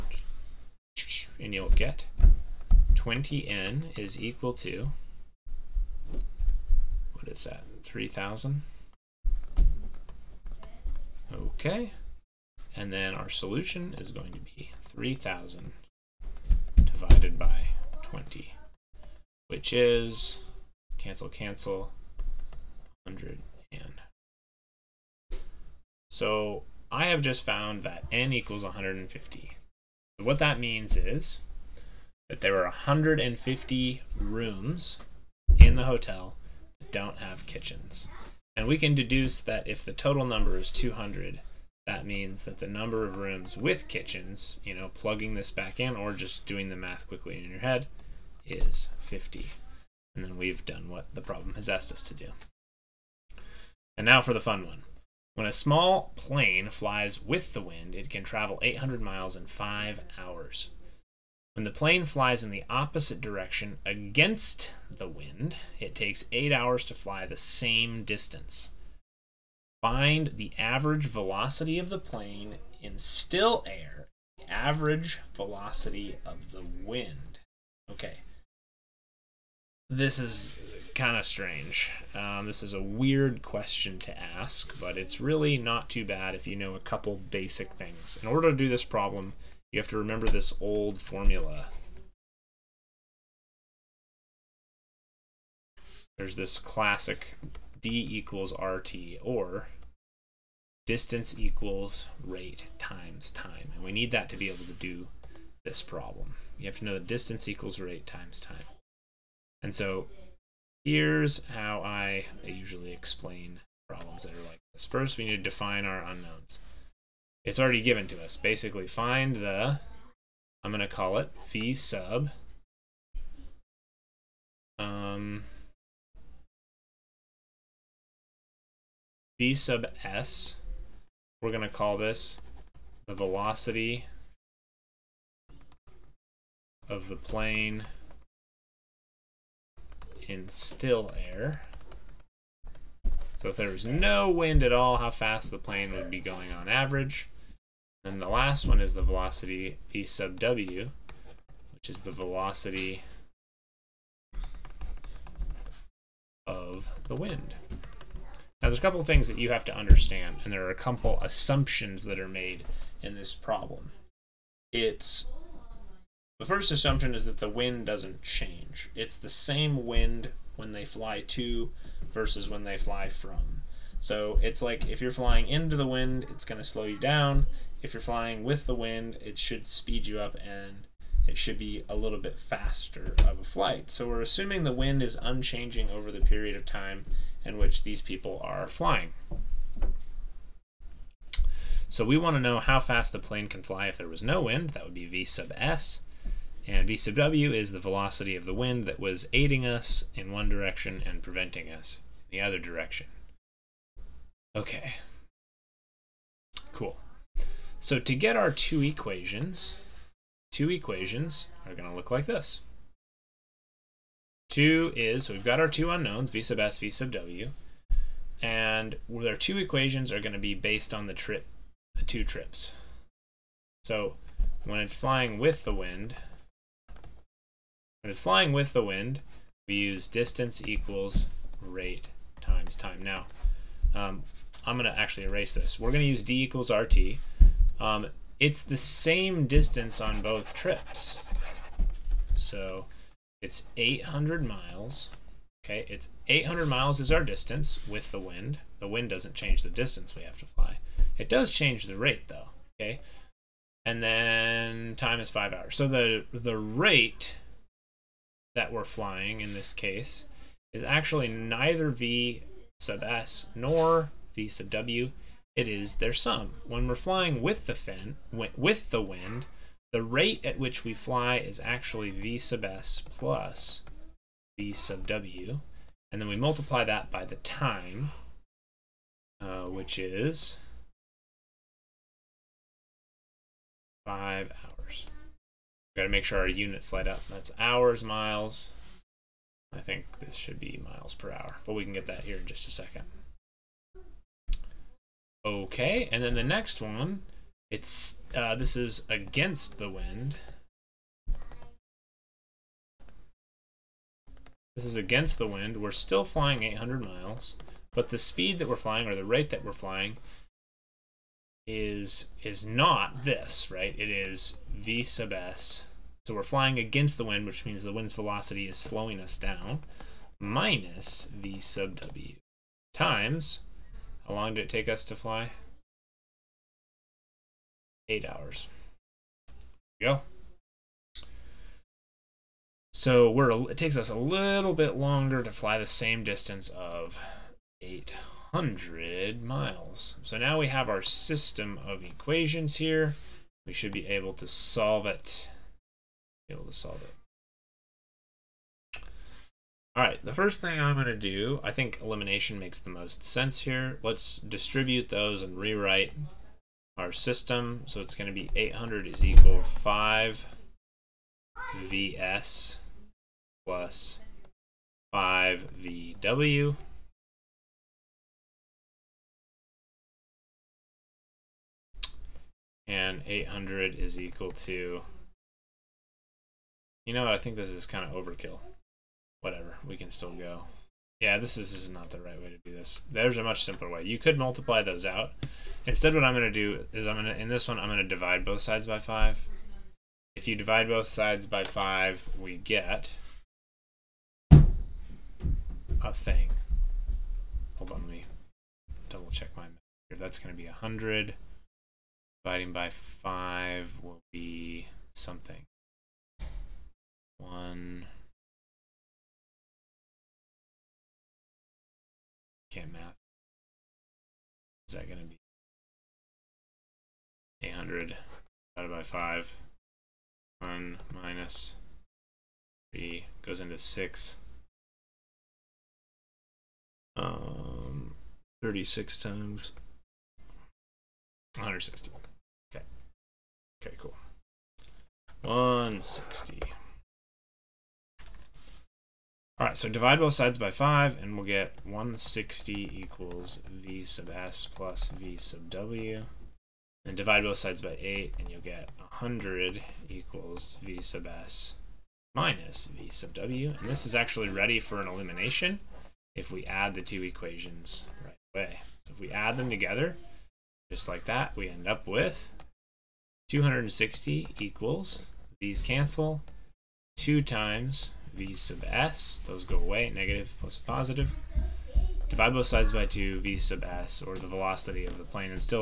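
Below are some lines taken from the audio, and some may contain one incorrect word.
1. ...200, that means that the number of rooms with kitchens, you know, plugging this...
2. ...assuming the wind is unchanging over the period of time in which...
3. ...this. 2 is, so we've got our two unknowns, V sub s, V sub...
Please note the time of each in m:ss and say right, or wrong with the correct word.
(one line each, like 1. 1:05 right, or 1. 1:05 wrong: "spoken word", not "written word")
1. 0:40 right
2. 3:04 right
3. 3:32 right.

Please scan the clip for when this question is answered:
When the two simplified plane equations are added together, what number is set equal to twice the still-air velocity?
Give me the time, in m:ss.
7:43.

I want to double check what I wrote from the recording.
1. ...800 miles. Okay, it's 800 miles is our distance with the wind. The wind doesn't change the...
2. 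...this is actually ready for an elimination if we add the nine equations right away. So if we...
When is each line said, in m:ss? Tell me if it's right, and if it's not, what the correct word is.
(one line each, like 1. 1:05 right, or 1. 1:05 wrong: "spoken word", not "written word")
1. 4:03 right
2. 7:33 wrong: "two", not "nine".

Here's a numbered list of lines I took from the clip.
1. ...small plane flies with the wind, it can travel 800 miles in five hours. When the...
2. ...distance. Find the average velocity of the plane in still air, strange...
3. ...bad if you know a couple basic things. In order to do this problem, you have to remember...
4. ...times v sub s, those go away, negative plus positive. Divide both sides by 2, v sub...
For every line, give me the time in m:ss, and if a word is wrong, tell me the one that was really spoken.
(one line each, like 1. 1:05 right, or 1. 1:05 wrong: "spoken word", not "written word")
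1. 0:55 right
2. 1:08 wrong: "average", not "strange"
3. 1:26 right
4. 7:47 right.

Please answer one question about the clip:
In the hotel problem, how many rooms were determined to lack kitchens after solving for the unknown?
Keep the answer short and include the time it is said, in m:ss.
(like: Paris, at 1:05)
150, at 0:32.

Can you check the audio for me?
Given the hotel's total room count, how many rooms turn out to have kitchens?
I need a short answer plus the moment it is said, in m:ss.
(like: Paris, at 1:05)
50, at 0:48.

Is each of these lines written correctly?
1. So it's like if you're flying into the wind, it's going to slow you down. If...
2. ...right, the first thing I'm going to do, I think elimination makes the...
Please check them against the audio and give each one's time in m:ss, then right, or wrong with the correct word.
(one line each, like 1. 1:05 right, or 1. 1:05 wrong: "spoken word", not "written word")
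1. 2:53 right
2. 5:50 right.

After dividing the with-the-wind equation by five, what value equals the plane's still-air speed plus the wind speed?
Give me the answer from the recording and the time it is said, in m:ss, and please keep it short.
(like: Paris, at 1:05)
160, at 7:21.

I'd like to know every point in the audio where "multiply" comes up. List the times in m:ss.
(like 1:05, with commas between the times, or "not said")
4:36, 6:24.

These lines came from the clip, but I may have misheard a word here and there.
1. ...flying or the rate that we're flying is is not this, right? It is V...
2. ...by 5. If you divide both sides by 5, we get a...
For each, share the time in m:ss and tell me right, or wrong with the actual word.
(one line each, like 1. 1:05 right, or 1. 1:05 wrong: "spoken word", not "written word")
1. 5:08 right
2. 6:28 right.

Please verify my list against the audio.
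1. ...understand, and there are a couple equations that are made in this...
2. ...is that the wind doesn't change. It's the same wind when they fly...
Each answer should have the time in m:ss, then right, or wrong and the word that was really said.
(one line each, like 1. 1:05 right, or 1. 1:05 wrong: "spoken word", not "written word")
1. 2:39 wrong: "assumptions", not "equations"
2. 2:47 right.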